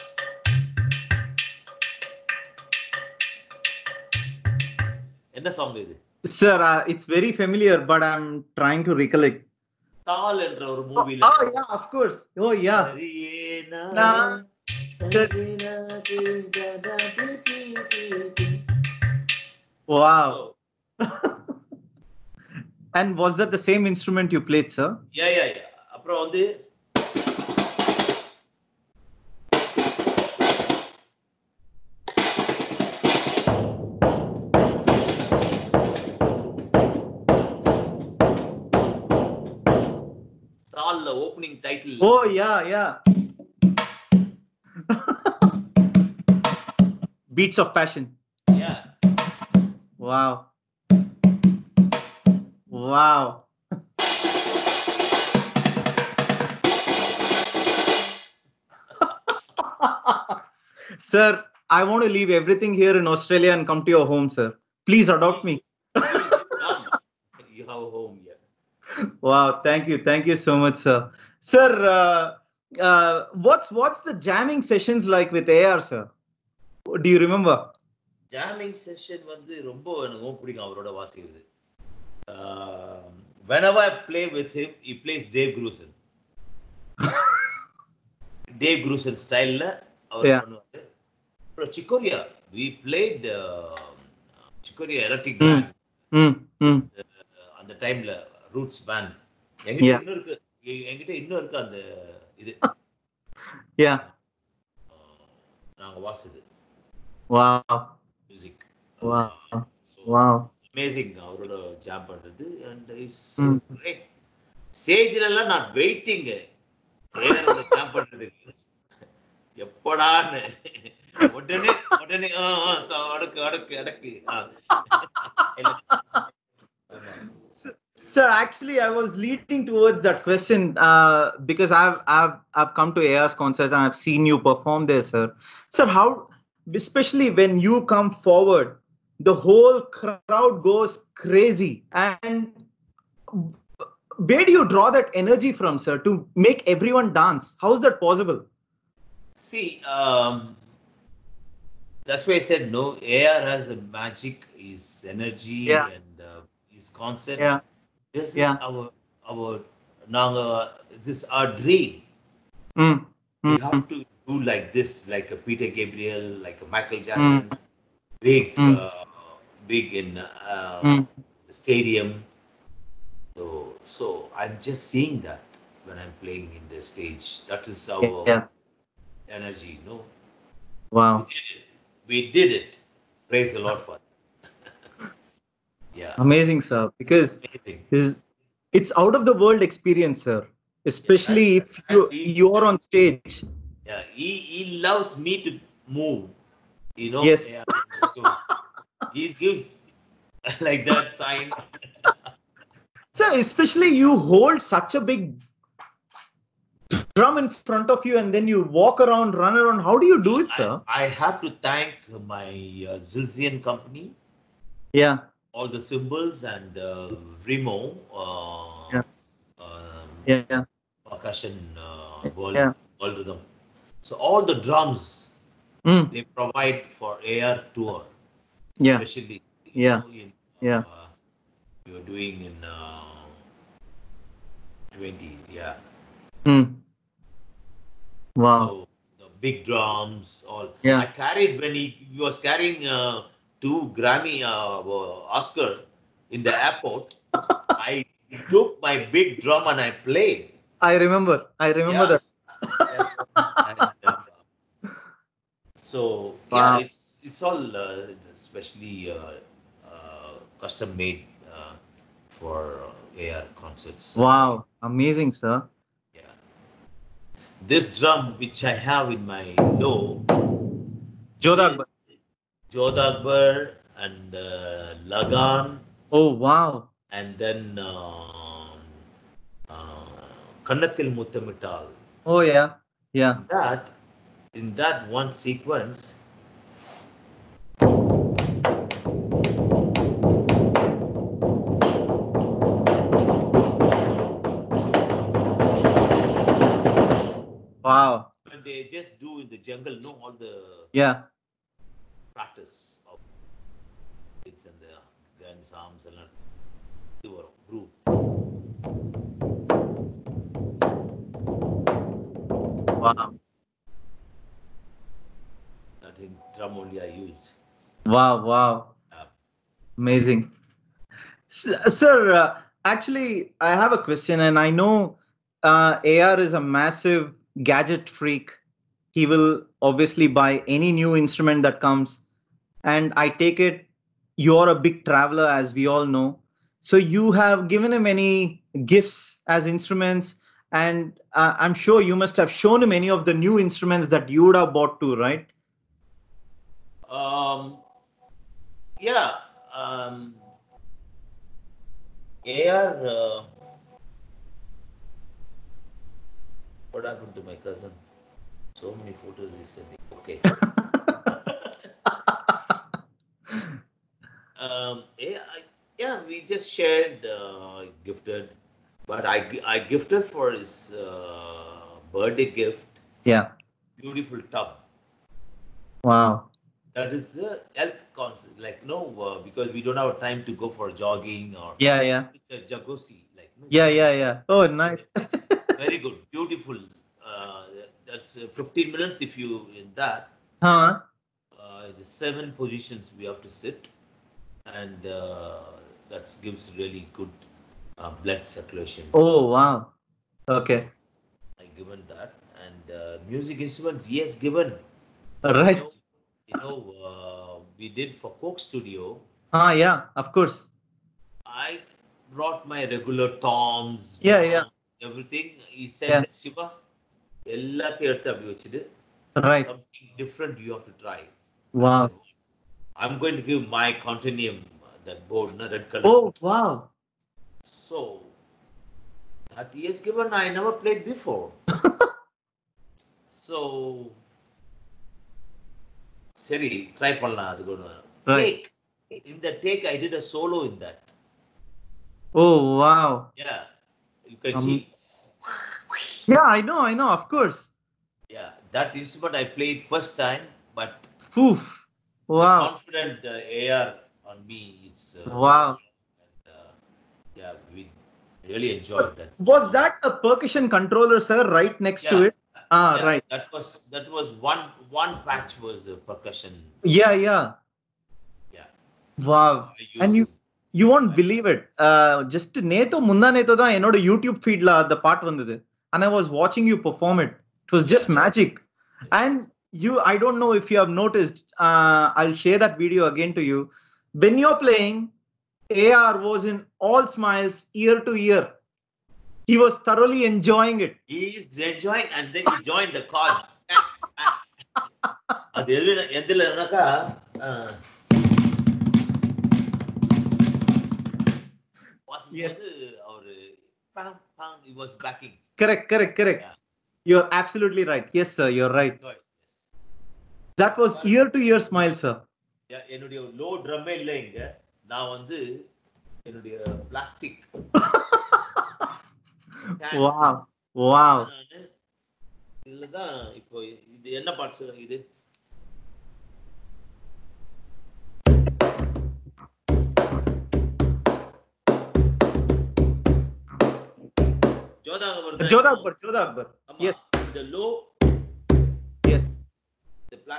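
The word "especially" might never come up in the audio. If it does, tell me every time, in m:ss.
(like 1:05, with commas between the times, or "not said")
2:16, 3:10, 3:23, 3:48, 4:18.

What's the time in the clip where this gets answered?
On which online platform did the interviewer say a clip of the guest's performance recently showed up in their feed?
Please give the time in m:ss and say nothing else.
7:54.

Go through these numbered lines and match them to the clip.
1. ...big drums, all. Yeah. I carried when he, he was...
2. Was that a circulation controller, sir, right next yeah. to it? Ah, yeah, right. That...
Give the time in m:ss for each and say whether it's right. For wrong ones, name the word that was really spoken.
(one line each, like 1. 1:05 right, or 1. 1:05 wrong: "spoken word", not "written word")
1. 3:59 right
2. 7:39 wrong: "percussion", not "circulation".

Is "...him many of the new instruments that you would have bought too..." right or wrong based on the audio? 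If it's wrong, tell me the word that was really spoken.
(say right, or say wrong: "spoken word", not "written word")
right.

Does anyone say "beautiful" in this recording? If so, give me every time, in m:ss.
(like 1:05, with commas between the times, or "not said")
6:13, 6:26.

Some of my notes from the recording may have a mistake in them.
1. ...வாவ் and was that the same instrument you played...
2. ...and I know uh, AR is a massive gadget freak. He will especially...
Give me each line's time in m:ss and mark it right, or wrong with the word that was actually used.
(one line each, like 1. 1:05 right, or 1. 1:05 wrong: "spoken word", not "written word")
1. 0:19 right
2. 5:24 wrong: "obviously", not "especially".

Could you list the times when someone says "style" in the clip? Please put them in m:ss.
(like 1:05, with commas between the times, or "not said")
1:29.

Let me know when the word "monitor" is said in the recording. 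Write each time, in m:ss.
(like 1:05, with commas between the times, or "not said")
not said.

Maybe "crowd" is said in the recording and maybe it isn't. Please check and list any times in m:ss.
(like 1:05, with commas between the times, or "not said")
2:19.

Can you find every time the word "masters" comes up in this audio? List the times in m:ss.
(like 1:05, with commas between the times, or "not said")
not said.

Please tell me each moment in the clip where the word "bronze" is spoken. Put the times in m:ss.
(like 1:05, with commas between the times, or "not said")
not said.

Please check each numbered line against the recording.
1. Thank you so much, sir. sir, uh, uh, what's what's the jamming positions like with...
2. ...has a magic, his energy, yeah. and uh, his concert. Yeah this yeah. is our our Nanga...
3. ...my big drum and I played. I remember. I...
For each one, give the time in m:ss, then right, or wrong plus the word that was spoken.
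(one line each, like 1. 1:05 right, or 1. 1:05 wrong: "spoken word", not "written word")
1. 1:09 wrong: "sessions", not "positions"
2. 2:33 right
3. 4:08 right.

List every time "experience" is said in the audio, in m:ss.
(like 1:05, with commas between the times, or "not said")
3:09.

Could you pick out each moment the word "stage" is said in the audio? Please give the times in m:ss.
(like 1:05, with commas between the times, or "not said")
2:56, 3:12.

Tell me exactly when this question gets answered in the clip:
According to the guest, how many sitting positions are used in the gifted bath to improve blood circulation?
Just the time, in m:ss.
6:32.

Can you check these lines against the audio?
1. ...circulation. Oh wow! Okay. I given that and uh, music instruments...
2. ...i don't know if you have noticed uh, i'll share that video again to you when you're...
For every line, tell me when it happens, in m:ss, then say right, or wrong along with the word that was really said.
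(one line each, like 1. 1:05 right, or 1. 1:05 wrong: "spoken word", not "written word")
1. 6:38 right
2. 8:00 right.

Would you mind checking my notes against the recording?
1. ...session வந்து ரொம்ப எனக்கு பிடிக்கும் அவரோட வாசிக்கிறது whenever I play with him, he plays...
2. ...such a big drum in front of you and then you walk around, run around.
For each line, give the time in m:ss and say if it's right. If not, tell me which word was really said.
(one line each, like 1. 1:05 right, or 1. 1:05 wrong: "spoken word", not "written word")
1. 1:18 right
2. 3:24 right.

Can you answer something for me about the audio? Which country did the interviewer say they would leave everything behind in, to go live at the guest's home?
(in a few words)
Australia.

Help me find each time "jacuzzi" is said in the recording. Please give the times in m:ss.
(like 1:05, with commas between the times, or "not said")
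6:22.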